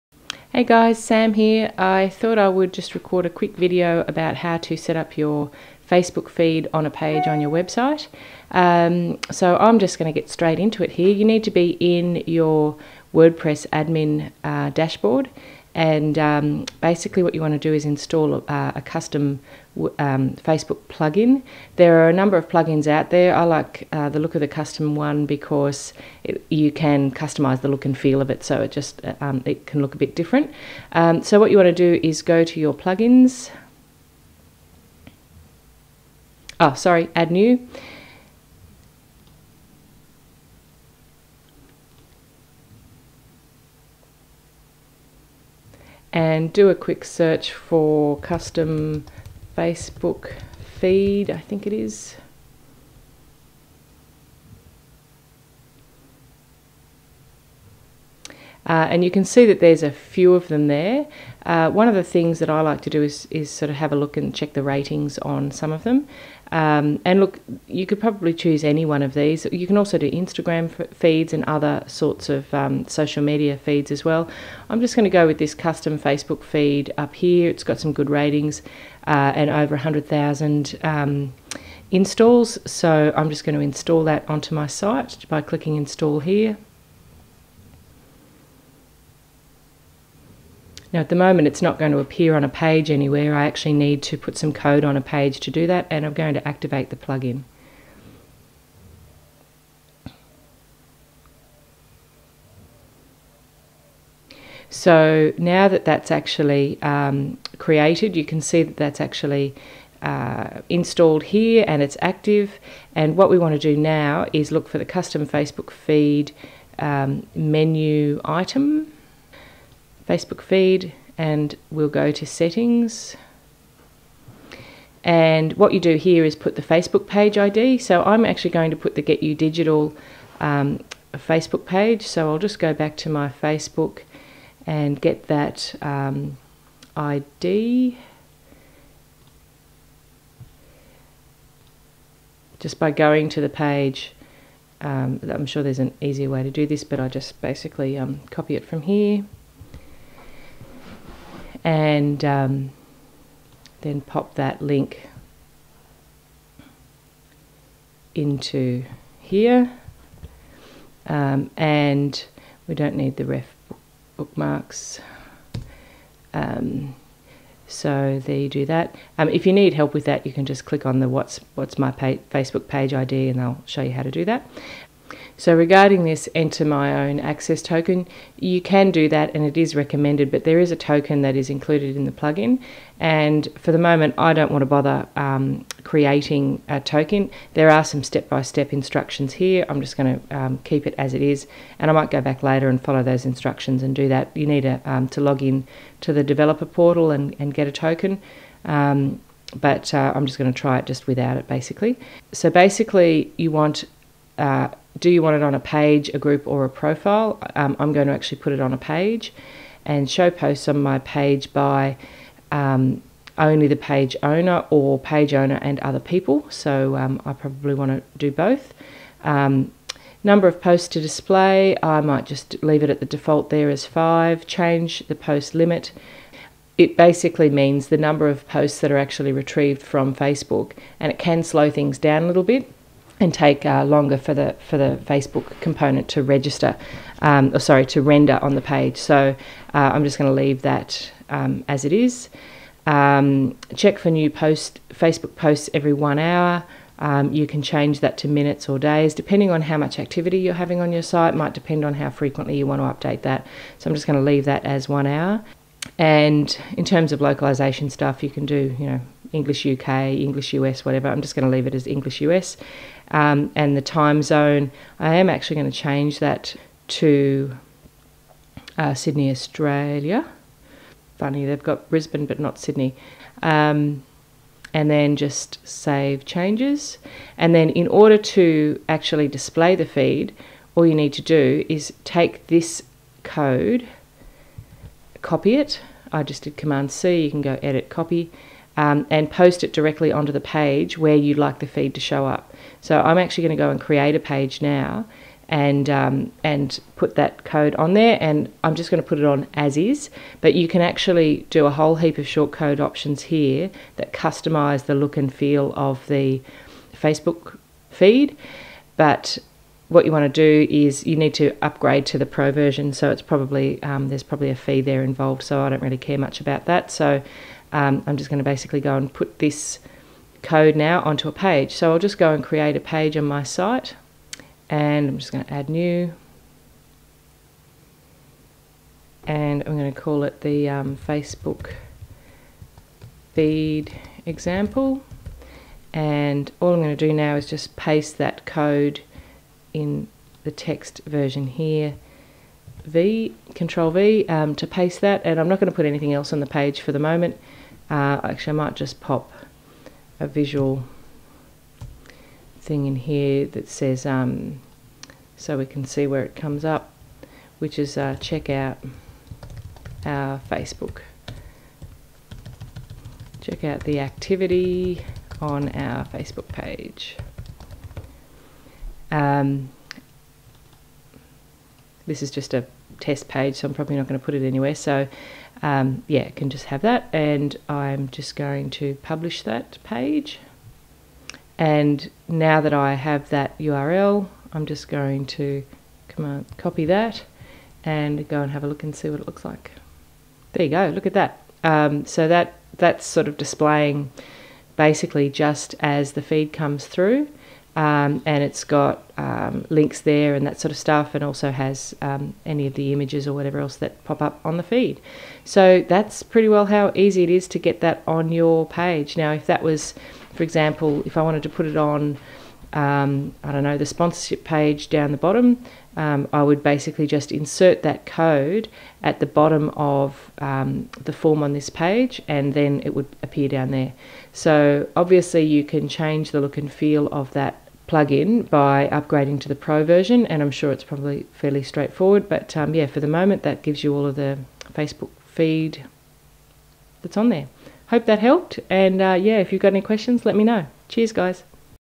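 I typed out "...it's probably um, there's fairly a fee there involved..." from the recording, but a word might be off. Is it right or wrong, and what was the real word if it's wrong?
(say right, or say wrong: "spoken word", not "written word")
wrong: "probably", not "fairly".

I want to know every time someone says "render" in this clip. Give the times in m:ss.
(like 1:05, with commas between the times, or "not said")
3:58.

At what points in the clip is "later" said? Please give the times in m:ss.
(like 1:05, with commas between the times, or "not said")
3:12.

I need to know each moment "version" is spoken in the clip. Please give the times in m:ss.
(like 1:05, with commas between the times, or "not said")
5:12, 5:41, 7:09.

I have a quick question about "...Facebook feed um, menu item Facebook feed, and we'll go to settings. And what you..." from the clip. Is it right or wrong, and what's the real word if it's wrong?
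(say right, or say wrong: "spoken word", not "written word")
right.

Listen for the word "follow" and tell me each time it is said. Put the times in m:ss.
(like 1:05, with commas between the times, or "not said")
3:12.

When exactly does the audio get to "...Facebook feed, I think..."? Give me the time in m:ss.
0:49.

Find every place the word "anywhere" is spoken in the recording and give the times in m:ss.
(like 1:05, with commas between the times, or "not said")
1:32, 6:14.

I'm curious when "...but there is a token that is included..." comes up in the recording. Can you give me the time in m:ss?
3:00.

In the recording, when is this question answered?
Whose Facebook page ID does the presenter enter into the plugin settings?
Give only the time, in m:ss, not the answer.
2:09.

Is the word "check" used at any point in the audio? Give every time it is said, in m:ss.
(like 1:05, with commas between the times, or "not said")
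1:04, 4:03, 5:58, 6:03.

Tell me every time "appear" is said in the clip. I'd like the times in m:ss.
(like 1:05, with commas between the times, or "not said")
1:31, 7:03.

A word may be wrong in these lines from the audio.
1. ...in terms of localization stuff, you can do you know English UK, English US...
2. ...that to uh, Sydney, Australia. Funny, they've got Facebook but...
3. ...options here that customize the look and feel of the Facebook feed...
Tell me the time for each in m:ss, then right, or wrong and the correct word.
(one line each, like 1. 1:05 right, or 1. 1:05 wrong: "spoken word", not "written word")
1. 4:16 right
2. 4:26 wrong: "Brisbane", not "Facebook"
3. 5:02 right.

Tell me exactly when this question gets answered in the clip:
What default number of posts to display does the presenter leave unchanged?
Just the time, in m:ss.
3:43.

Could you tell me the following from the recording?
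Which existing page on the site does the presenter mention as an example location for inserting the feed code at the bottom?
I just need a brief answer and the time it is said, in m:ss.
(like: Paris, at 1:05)
sponsorship page, at 6:53.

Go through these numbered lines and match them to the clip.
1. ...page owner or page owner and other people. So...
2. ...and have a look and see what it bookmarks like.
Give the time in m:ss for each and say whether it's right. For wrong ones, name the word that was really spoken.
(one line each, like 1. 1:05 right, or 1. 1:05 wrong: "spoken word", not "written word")
1. 3:33 right
2. 6:28 wrong: "looks", not "bookmarks".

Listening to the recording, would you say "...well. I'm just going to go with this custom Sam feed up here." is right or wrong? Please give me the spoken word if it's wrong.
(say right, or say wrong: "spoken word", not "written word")
wrong: "Facebook", not "Sam".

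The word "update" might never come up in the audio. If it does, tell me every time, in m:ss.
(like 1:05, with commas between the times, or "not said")
4:13.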